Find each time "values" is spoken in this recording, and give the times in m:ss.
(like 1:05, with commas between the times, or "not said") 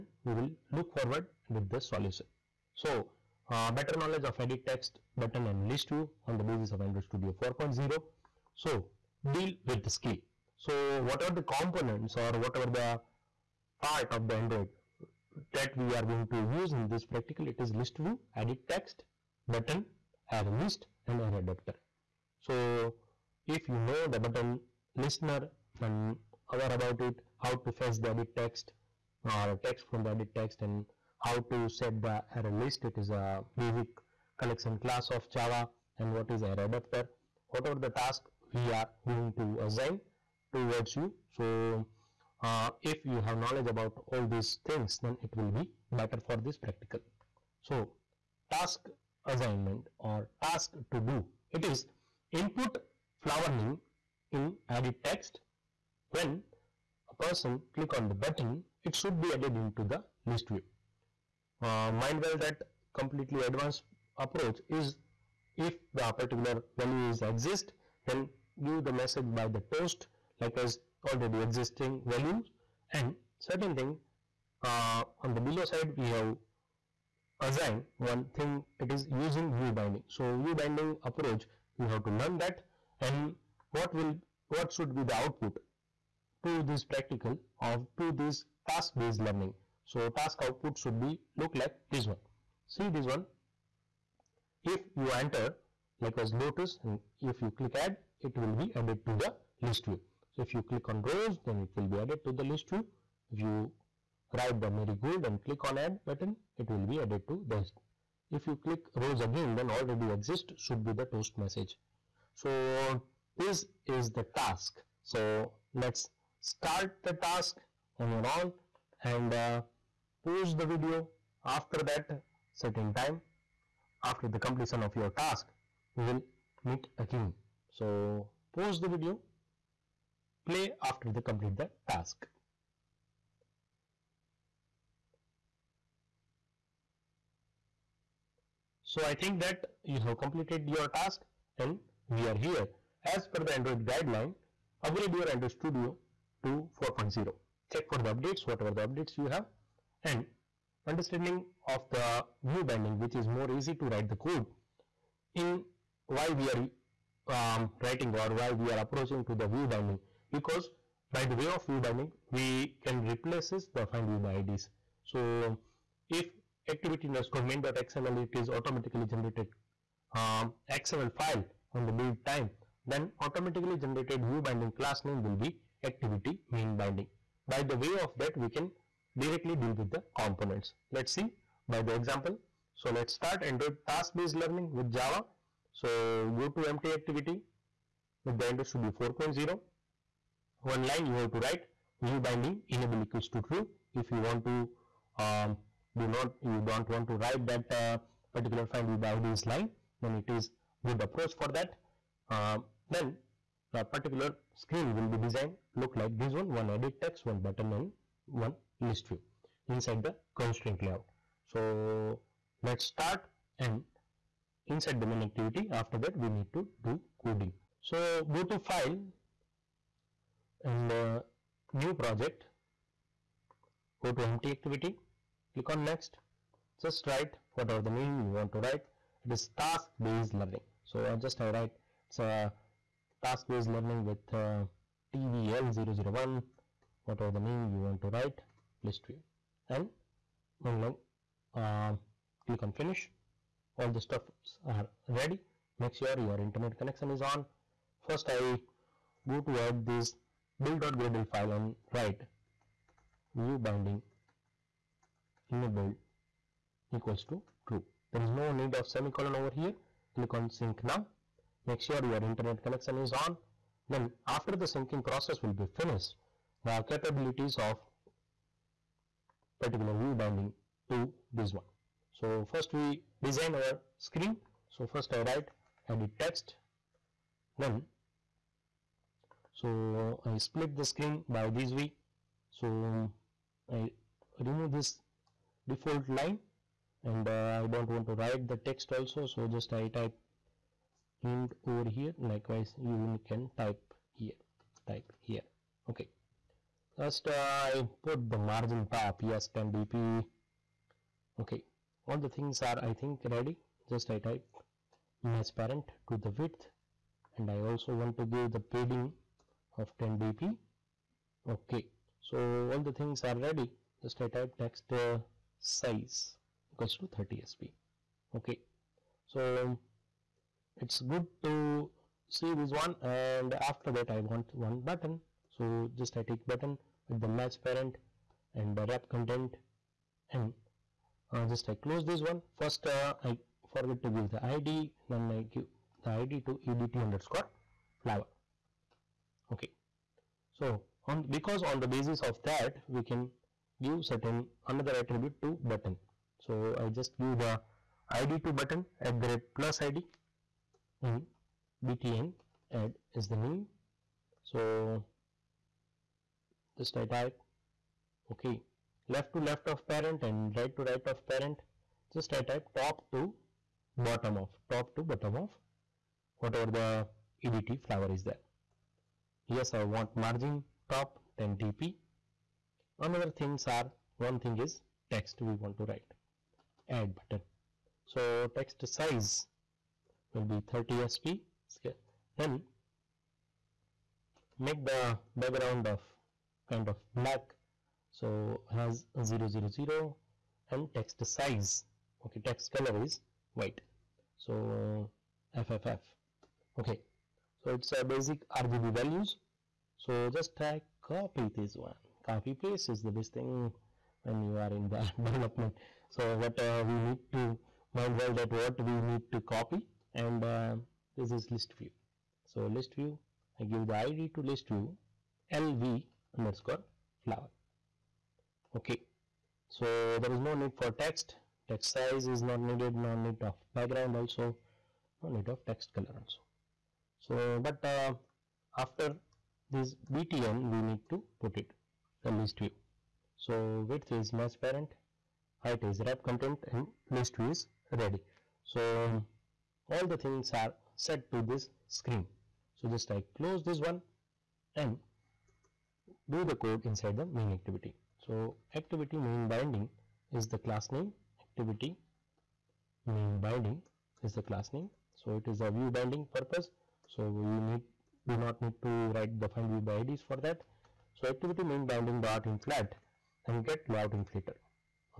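1:06, 1:12, 6:38.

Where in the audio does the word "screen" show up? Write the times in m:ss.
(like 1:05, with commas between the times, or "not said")
3:24, 4:33, 4:40, 7:21.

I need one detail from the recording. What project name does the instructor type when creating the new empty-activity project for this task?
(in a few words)
tbl001.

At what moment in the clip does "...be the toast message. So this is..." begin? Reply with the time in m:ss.
1:50.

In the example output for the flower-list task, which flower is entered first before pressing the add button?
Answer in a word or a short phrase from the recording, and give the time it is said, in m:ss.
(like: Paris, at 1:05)
Lotus, at 1:36.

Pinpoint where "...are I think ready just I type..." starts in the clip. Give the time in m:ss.
5:02.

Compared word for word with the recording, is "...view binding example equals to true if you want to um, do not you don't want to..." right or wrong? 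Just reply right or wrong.
wrong.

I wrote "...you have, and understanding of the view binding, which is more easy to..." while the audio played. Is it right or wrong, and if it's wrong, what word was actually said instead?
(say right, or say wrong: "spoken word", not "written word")
right.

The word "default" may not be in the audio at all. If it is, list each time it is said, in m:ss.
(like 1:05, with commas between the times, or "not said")
4:45.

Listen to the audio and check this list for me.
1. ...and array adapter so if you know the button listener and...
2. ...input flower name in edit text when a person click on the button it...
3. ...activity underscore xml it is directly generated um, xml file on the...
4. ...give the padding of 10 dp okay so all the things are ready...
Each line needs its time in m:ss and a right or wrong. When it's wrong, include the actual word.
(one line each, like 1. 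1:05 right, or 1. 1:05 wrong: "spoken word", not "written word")
1. 0:21 right
2. 0:52 right
3. 2:46 wrong: "automatically", not "directly"
4. 5:08 right.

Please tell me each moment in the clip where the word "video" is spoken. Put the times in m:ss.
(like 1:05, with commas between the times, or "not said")
2:00, 2:08.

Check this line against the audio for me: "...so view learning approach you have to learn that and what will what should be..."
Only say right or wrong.
wrong.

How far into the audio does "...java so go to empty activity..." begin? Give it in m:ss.
3:04.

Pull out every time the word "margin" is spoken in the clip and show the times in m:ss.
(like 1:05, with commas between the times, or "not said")
4:58, 6:10.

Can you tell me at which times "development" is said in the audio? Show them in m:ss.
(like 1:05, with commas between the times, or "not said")
6:45.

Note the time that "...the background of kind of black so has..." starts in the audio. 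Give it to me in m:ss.
6:24.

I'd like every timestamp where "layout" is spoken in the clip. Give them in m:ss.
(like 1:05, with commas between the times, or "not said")
3:30, 7:43.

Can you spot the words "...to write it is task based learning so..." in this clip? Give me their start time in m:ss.
3:48.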